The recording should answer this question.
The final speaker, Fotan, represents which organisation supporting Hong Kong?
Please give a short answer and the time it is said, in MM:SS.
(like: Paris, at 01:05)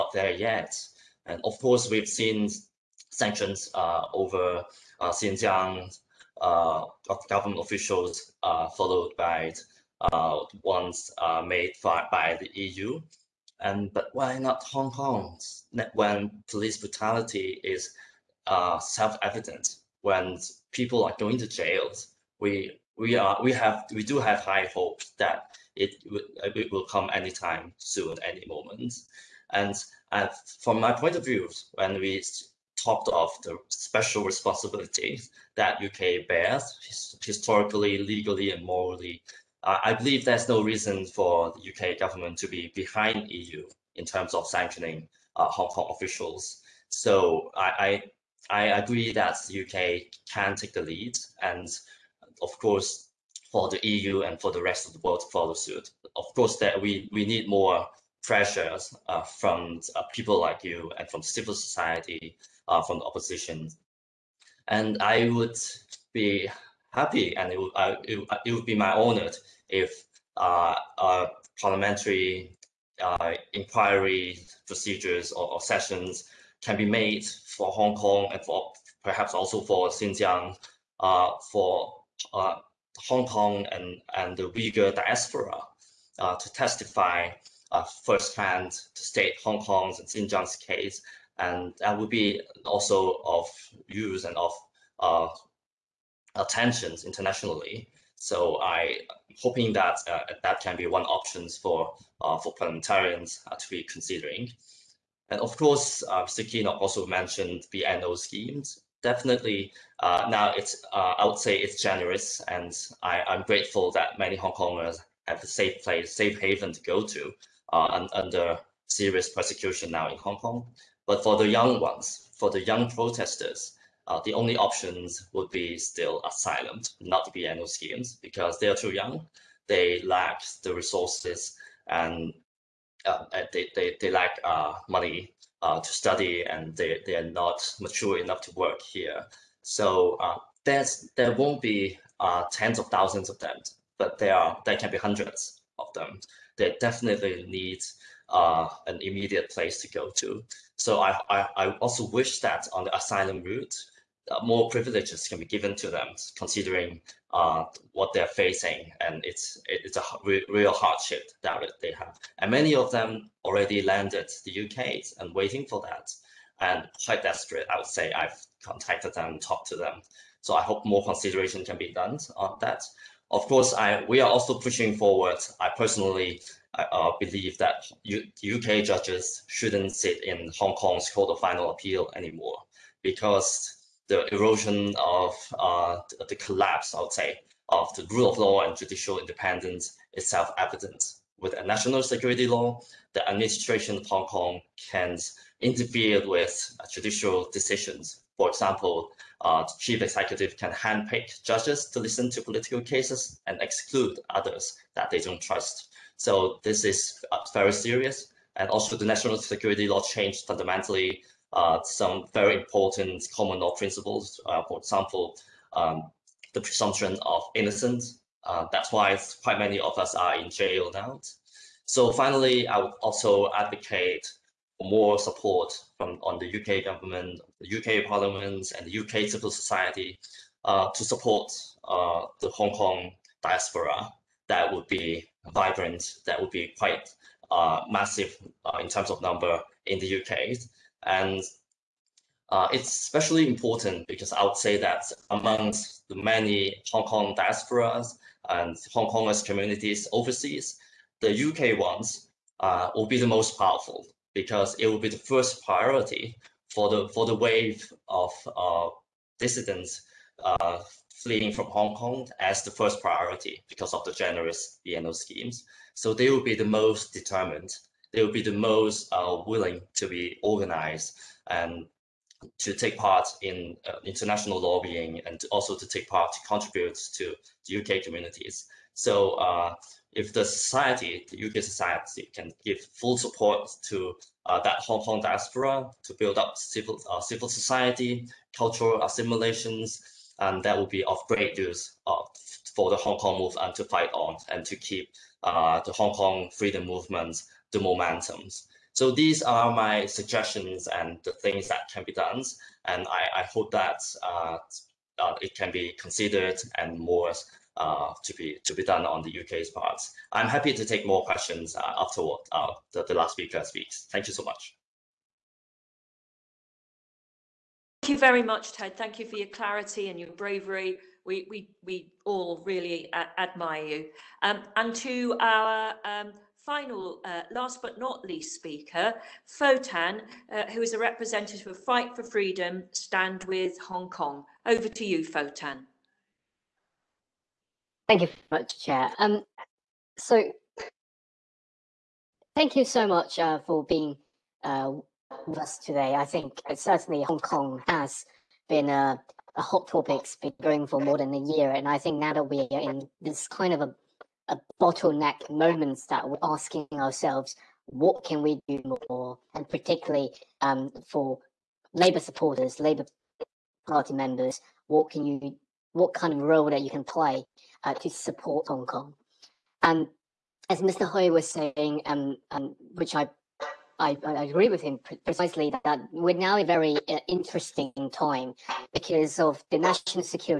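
Fight for Freedom, Stand with Hong Kong, at 05:31.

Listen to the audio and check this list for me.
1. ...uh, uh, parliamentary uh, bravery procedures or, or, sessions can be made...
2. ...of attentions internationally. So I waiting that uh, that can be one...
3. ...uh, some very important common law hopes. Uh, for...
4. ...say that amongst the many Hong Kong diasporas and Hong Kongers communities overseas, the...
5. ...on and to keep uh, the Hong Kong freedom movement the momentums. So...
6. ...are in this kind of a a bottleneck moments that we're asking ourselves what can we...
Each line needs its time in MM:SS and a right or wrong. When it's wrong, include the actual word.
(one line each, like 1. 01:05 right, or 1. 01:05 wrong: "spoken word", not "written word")
1. 01:10 wrong: "inquiry", not "bravery"
2. 01:34 wrong: "hoping", not "waiting"
3. 03:31 wrong: "principles", not "hopes"
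4. 04:04 right
5. 04:54 right
6. 05:52 right.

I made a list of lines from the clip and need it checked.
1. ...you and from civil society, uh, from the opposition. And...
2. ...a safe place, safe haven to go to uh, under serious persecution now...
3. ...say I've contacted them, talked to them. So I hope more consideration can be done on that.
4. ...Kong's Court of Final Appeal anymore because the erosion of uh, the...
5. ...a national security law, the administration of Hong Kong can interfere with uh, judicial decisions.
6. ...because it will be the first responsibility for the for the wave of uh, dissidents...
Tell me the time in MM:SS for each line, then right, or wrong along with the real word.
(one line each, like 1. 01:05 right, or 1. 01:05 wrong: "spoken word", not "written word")
1. 01:00 right
2. 01:55 right
3. 02:47 right
4. 03:00 right
5. 03:11 right
6. 04:14 wrong: "priority", not "responsibility".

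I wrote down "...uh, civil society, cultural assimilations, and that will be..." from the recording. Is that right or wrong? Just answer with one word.
right.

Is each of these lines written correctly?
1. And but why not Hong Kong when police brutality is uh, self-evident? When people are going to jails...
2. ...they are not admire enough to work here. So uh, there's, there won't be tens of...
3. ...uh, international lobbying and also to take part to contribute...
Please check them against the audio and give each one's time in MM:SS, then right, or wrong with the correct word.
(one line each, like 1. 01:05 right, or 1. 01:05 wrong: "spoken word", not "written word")
1. 00:13 right
2. 02:17 wrong: "mature", not "admire"
3. 04:33 right.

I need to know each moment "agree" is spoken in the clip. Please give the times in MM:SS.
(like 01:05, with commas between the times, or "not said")
00:48, 06:14.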